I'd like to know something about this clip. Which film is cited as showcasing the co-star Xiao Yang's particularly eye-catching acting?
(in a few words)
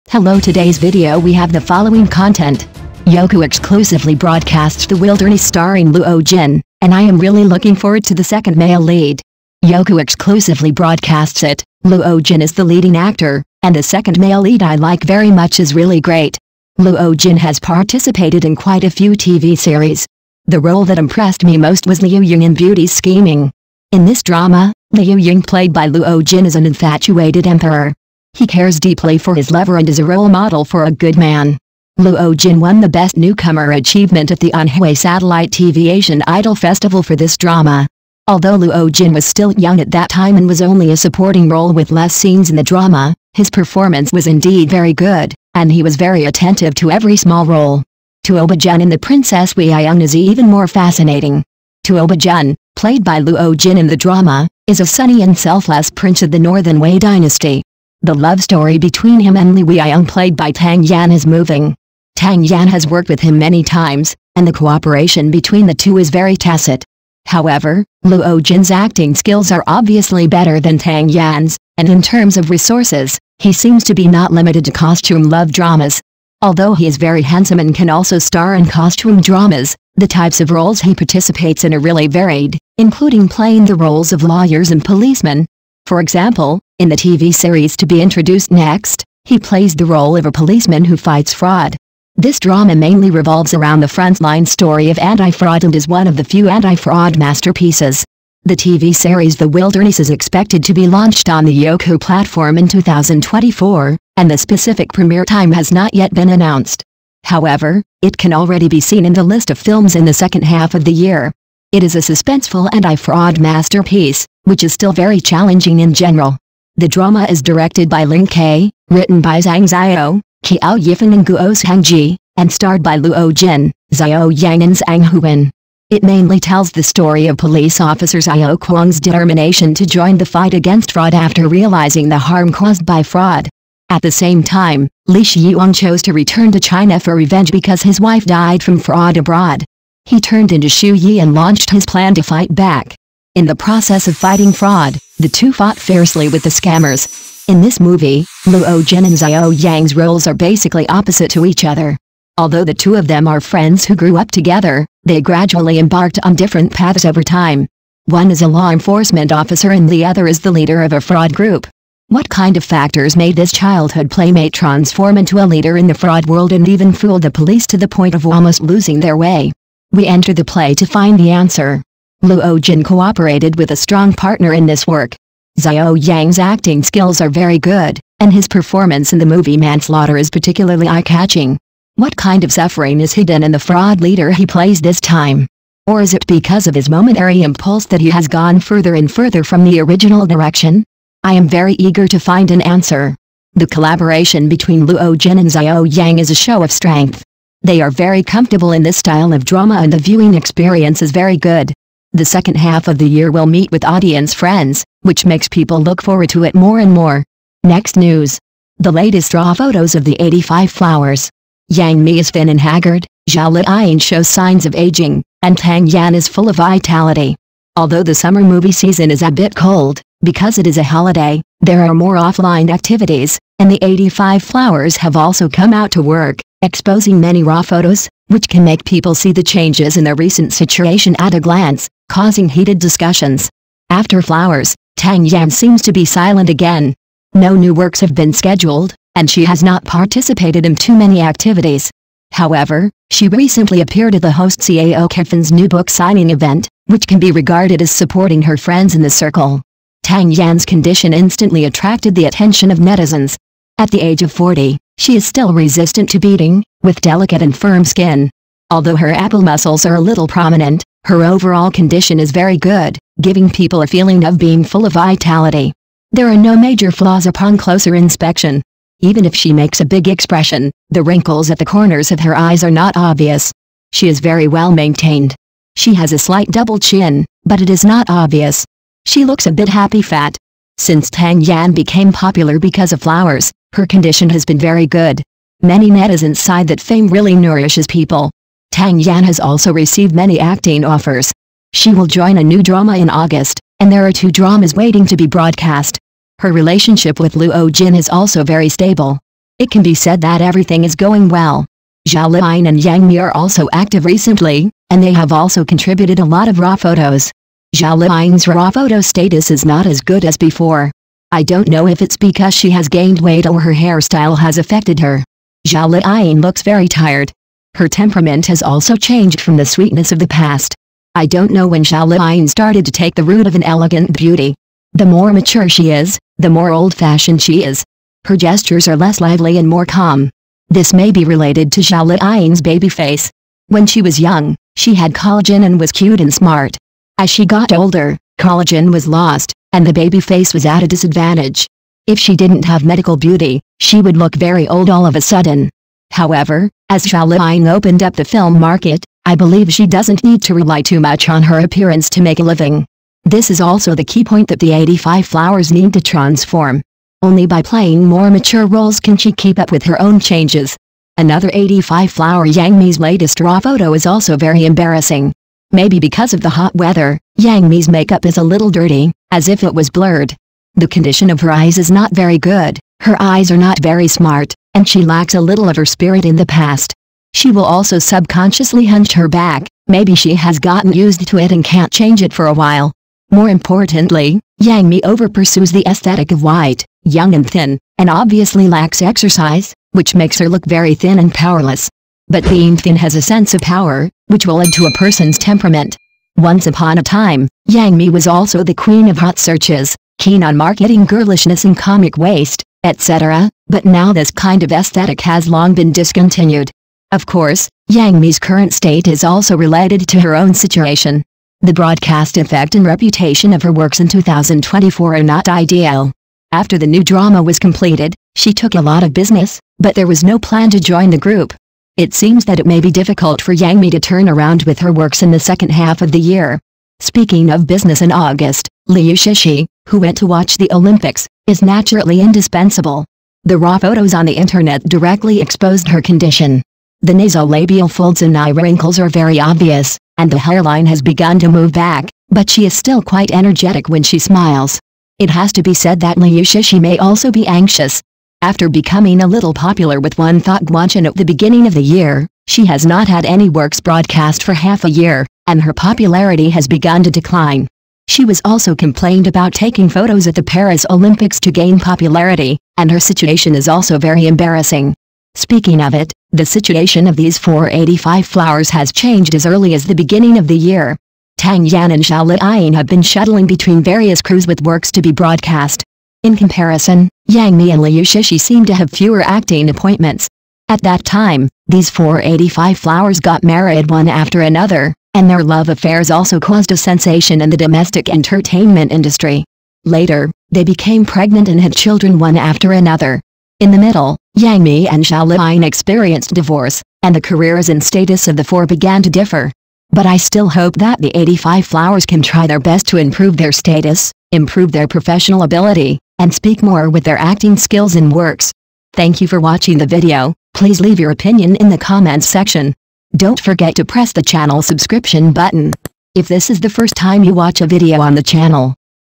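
Manslaughter.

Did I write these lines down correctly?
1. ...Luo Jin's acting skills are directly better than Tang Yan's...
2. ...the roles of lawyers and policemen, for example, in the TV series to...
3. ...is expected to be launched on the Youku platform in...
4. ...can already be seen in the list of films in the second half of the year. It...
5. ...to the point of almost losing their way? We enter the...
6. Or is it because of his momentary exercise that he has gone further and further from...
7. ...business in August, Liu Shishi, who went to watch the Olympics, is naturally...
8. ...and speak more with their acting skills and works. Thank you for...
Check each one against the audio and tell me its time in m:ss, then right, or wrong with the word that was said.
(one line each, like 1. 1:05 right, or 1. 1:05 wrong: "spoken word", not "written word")
1. 1:08 wrong: "obviously", not "directly"
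2. 1:23 right
3. 1:39 right
4. 1:48 right
5. 2:47 right
6. 3:05 wrong: "impulse", not "exercise"
7. 7:07 right
8. 8:26 right.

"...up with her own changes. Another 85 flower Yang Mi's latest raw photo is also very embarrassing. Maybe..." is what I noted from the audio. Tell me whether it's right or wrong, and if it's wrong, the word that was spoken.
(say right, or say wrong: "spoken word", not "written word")
right.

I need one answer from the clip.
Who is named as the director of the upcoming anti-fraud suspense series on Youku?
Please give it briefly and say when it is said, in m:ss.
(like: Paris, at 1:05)
Lin K, at 1:58.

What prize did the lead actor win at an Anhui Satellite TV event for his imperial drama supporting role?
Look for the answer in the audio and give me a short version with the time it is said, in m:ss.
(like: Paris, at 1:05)
Best Newcomer Achievement, at 0:32.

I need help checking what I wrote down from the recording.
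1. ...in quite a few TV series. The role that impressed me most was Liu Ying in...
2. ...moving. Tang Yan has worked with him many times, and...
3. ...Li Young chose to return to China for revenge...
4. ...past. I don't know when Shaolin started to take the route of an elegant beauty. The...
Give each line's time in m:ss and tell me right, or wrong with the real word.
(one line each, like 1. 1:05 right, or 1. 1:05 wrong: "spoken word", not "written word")
1. 0:18 right
2. 1:01 right
3. 2:15 wrong: "Xiyuan", not "Young"
4. 5:20 right.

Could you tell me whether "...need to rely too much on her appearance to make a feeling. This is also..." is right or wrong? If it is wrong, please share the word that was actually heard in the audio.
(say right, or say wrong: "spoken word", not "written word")
wrong: "living", not "feeling".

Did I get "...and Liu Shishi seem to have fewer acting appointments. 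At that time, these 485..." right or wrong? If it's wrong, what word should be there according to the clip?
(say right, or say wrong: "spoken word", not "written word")
right.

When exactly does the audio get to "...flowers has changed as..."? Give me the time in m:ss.
7:48.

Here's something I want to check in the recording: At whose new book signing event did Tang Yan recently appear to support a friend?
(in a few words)
CAO Kevin.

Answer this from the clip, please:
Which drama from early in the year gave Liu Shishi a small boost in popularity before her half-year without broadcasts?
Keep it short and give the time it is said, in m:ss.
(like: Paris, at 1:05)
One Thought Guanchen, at 7:30.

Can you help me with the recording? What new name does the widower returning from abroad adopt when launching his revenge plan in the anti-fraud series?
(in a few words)
Xu Yi.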